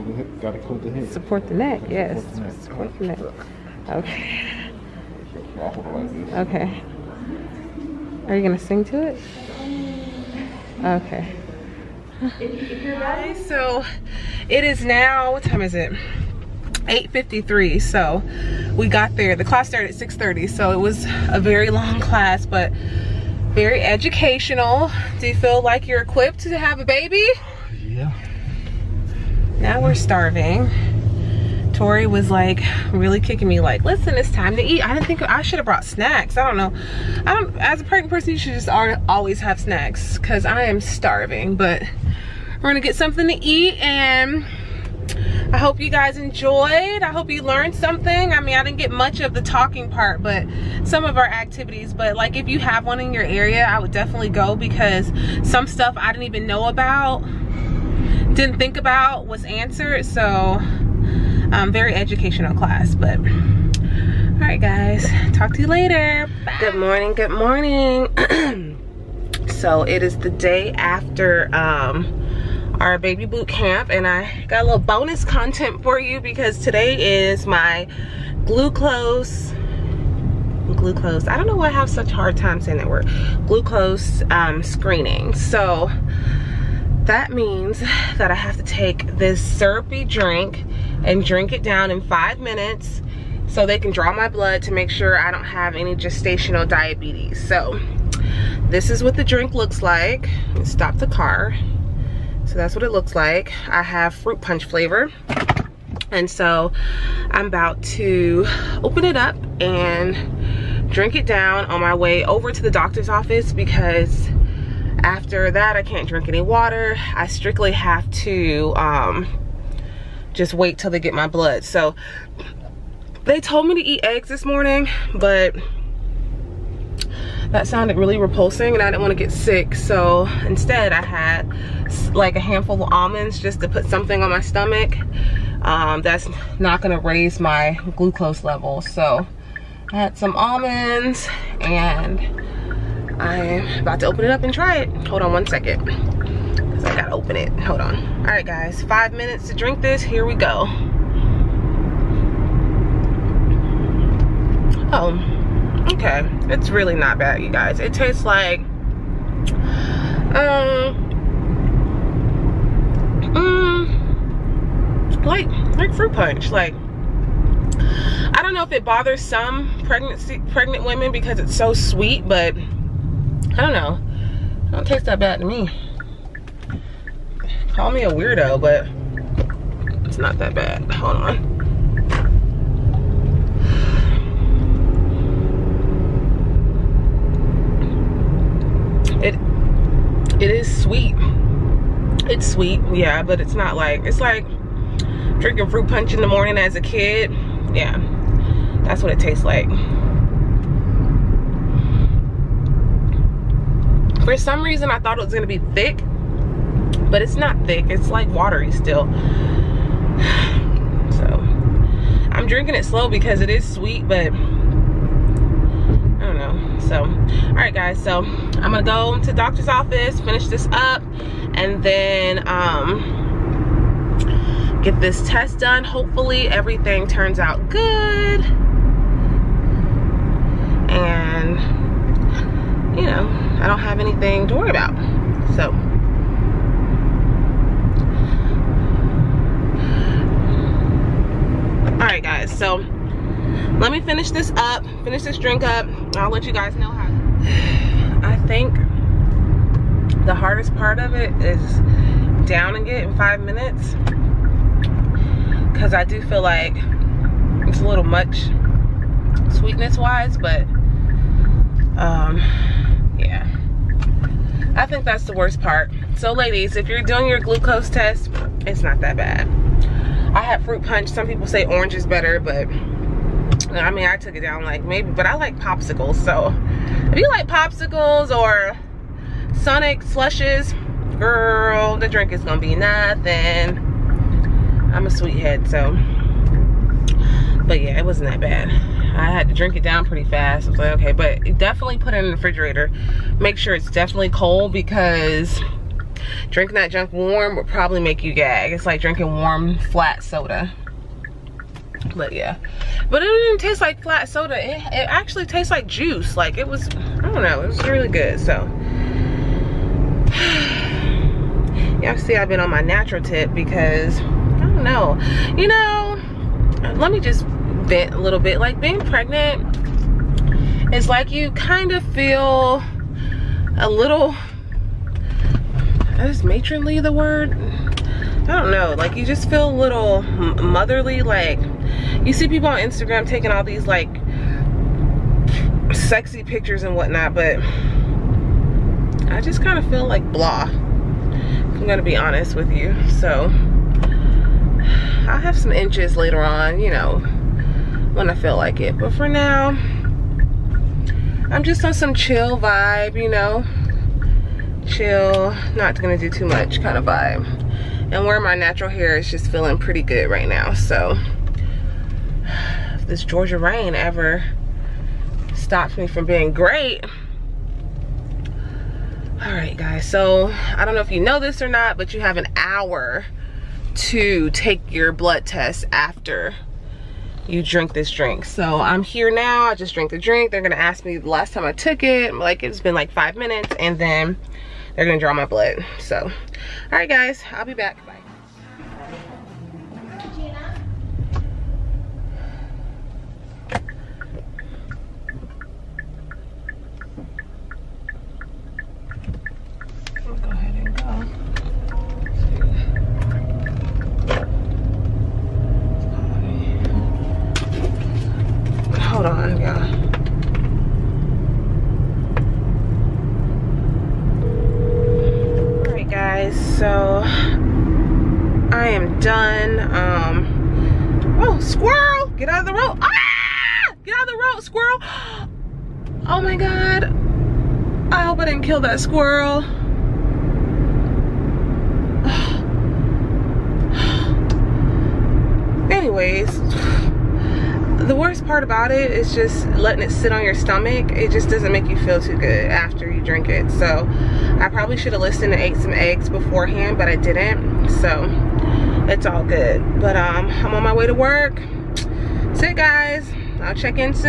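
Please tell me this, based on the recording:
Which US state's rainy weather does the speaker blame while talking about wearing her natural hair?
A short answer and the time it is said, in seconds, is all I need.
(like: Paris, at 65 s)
Georgia, at 363 s.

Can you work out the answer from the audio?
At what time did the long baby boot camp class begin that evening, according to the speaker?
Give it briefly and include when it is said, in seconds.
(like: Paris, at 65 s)
6:30, at 20 s.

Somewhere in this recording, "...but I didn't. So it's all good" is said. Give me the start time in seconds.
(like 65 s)
446 s.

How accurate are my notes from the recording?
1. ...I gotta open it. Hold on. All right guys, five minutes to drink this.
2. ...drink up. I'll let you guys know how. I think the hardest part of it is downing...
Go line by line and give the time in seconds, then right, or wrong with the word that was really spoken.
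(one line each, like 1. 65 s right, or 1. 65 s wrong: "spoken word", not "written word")
1. 146 s right
2. 245 s right.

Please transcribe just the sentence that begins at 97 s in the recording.
So this is what the drink looks like.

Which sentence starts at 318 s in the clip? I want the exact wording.
Like being pregnant It's like you kind of feel a little, is matronly the word?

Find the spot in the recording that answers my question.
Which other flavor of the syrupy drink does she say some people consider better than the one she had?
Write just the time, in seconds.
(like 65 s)
271 s.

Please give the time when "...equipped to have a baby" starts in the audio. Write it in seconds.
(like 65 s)
26 s.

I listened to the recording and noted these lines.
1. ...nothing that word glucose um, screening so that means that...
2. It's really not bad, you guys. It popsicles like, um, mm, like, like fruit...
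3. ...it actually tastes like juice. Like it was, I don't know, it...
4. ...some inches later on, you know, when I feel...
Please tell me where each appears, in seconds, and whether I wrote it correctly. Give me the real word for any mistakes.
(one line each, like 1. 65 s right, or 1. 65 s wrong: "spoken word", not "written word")
1. 82 s wrong: "saying", not "nothing"
2. 156 s wrong: "tastes", not "popsicles"
3. 304 s right
4. 345 s right.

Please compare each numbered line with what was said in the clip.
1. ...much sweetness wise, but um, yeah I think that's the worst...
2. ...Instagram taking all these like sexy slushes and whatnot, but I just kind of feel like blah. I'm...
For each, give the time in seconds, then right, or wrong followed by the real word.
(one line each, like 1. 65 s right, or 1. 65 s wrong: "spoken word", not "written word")
1. 258 s right
2. 332 s wrong: "pictures", not "slushes".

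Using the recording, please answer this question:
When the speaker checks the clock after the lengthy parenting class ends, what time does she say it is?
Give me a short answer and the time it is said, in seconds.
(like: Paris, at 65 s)
8:53, at 16 s.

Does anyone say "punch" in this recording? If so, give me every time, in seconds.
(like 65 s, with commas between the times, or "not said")
104 s, 166 s, 195 s, 270 s.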